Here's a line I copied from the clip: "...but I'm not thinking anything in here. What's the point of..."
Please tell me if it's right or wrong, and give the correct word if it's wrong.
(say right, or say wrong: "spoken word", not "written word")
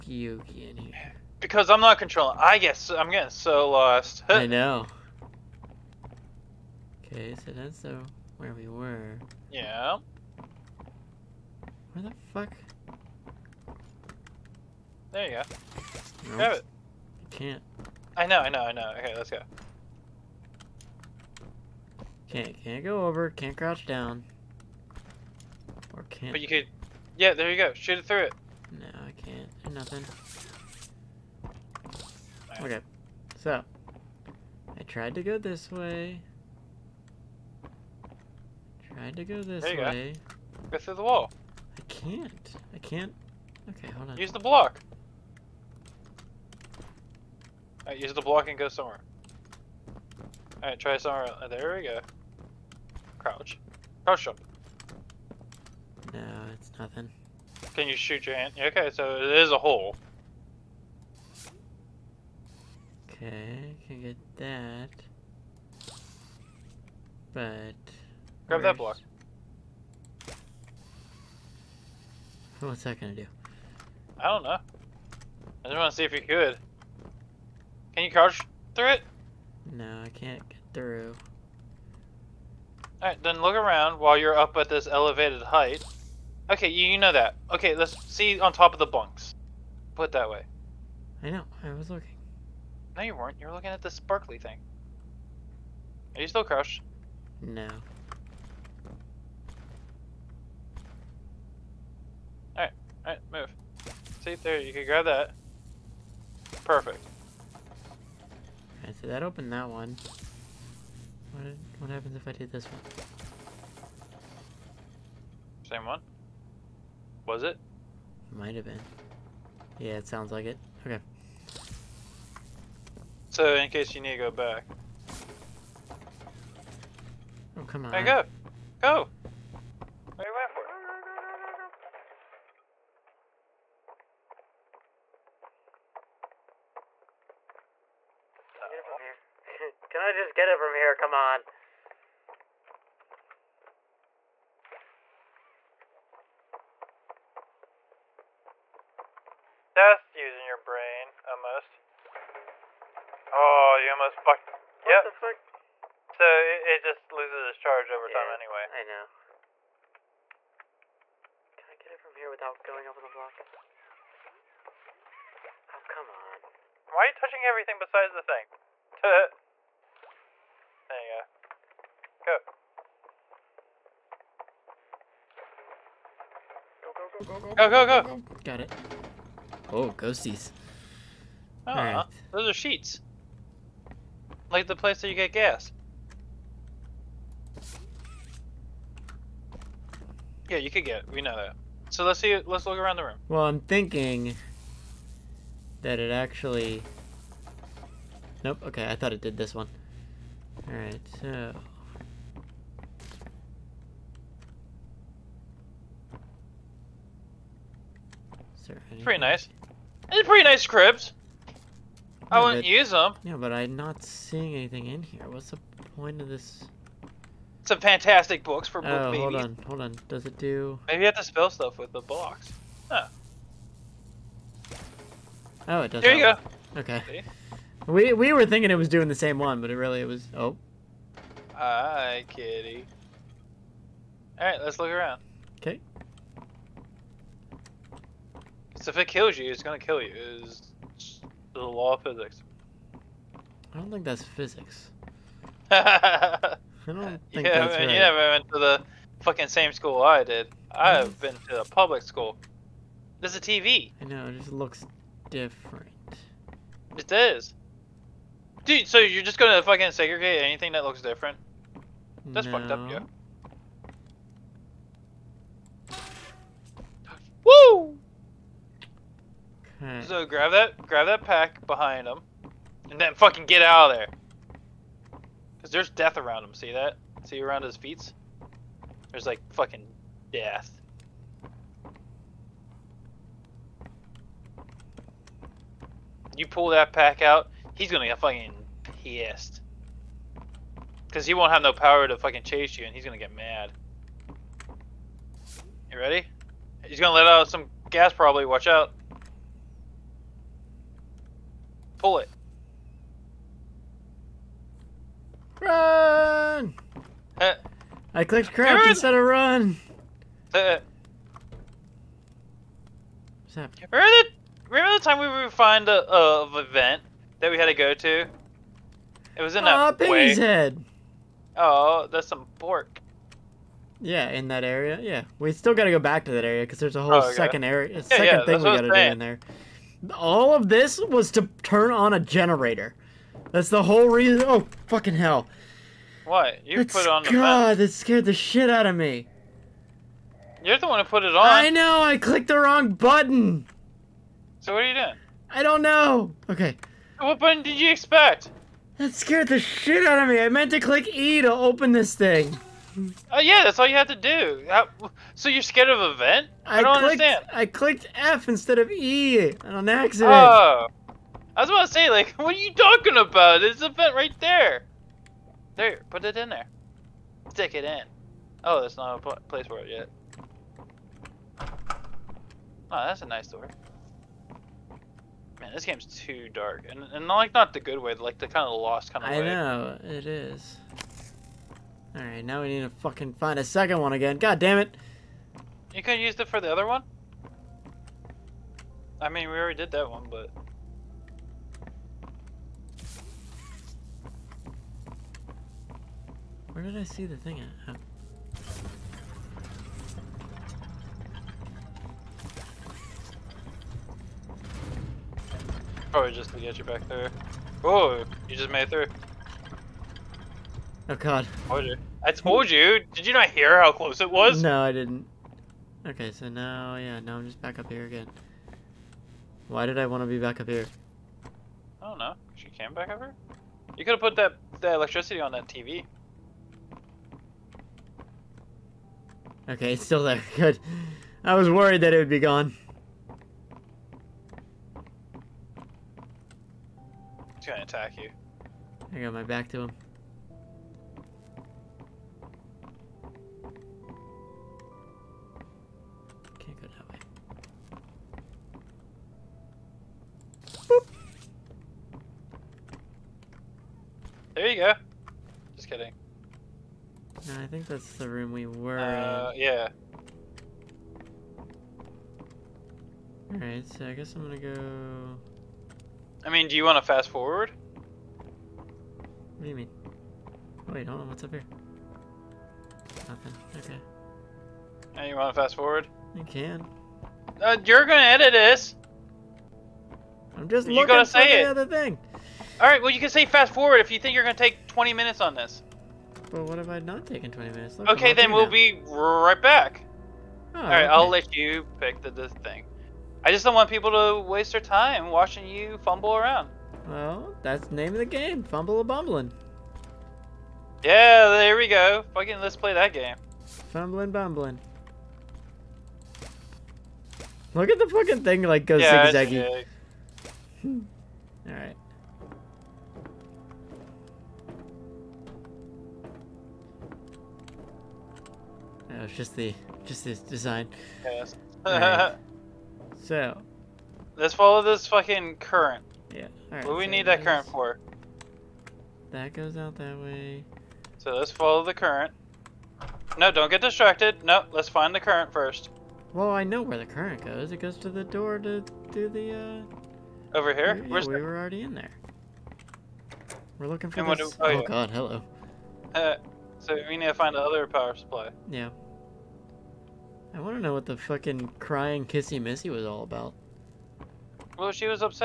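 wrong: "seeing", not "thinking".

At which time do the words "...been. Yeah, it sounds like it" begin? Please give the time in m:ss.
1:58.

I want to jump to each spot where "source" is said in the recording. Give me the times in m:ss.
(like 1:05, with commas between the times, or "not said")
not said.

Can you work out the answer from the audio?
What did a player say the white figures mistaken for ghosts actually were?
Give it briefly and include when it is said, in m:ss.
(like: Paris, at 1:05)
sheets, at 3:02.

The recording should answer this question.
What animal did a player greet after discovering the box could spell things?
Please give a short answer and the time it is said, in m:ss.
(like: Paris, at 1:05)
kitty, at 3:52.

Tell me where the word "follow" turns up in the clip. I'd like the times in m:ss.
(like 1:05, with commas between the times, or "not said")
8:44, 8:51.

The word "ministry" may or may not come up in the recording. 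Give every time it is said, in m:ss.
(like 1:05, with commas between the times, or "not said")
not said.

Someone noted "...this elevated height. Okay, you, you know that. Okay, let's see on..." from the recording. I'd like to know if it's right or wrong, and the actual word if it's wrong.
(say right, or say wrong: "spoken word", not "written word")
right.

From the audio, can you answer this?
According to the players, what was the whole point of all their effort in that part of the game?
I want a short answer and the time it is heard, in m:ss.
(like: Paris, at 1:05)
turn on a generator, at 5:31.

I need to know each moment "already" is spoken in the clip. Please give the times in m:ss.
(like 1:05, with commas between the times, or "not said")
6:29, 9:01.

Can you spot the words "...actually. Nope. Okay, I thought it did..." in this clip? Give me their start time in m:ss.
3:16.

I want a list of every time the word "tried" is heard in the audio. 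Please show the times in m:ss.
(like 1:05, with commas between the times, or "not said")
0:34, 0:38.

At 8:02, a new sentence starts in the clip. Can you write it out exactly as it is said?
Alright, well you can say fast forward if you think you're going to take 20 minutes on this.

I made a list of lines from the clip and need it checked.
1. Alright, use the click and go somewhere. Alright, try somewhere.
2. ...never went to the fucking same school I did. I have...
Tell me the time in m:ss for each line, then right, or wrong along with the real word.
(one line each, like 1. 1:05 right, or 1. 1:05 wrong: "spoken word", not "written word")
1. 0:47 wrong: "block", not "click"
2. 4:07 right.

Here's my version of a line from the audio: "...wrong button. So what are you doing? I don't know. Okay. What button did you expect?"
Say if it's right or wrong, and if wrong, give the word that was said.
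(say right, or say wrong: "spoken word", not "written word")
right.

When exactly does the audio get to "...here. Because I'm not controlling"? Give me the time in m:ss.
0:00.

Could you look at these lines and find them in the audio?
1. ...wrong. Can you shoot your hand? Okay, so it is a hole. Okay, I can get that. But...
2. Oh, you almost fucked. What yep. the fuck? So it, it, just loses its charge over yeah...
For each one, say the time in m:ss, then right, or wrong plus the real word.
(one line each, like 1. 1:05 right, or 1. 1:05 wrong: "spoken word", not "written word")
1. 0:56 wrong: "nothing", not "wrong"
2. 2:33 right.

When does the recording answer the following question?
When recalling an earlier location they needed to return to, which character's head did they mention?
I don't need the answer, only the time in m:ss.
5:19.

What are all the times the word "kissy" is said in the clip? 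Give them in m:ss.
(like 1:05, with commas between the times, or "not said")
9:12.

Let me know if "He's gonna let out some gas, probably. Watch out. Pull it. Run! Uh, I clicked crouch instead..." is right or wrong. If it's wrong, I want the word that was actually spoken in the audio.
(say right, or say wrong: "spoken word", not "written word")
right.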